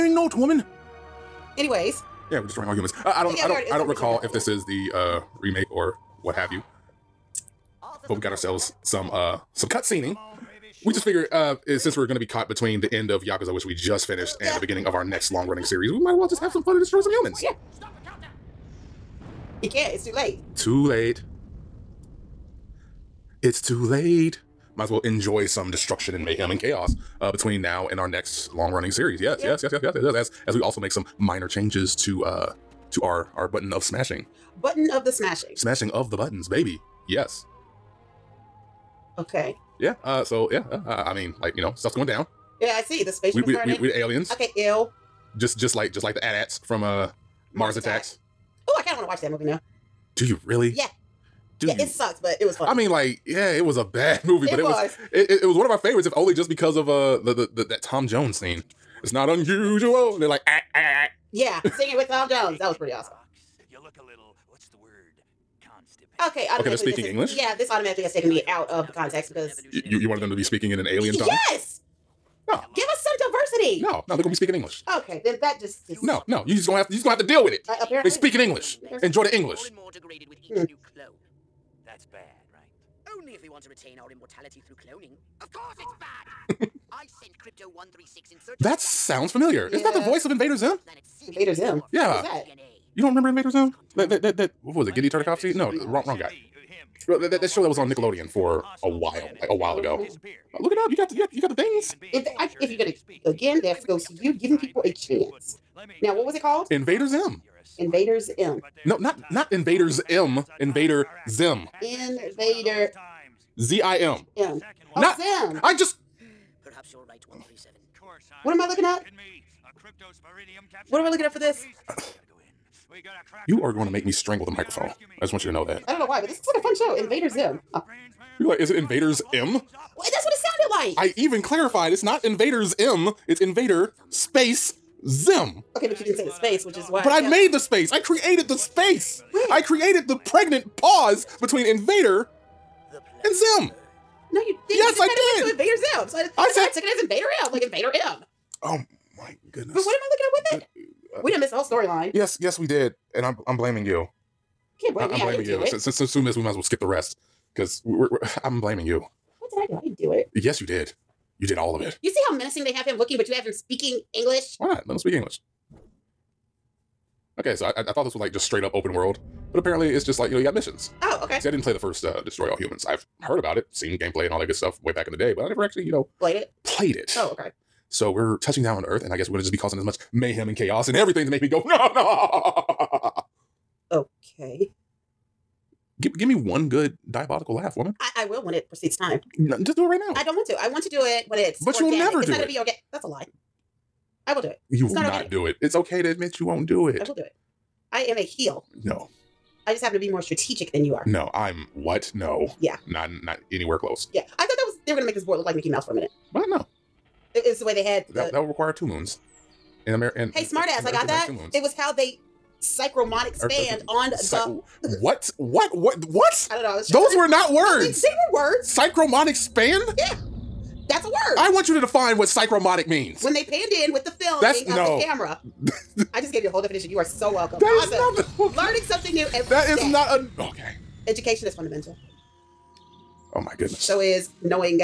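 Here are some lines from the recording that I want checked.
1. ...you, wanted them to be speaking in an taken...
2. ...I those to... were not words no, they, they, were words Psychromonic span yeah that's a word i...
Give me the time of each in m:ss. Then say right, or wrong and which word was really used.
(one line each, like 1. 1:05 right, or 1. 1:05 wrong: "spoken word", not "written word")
1. 1:09 wrong: "alien", not "taken"
2. 3:36 right.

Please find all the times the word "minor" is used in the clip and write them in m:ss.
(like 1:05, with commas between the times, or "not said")
0:31.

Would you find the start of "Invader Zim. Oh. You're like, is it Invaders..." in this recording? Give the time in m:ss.
2:06.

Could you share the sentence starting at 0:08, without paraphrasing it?
But we got ourselves some uh, some cutscening.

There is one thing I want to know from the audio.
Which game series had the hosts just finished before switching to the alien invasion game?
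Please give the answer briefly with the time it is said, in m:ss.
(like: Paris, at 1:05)
Yakuza, at 0:13.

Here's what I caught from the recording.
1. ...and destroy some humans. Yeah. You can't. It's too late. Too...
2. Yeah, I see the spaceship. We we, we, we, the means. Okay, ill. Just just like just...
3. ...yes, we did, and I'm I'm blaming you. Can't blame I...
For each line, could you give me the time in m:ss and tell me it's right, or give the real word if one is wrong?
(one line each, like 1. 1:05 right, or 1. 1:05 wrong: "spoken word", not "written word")
1. 0:16 right
2. 0:42 wrong: "aliens", not "means"
3. 2:32 right.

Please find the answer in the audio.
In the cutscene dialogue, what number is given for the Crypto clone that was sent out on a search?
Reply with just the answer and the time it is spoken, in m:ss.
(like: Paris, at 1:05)
136, at 1:27.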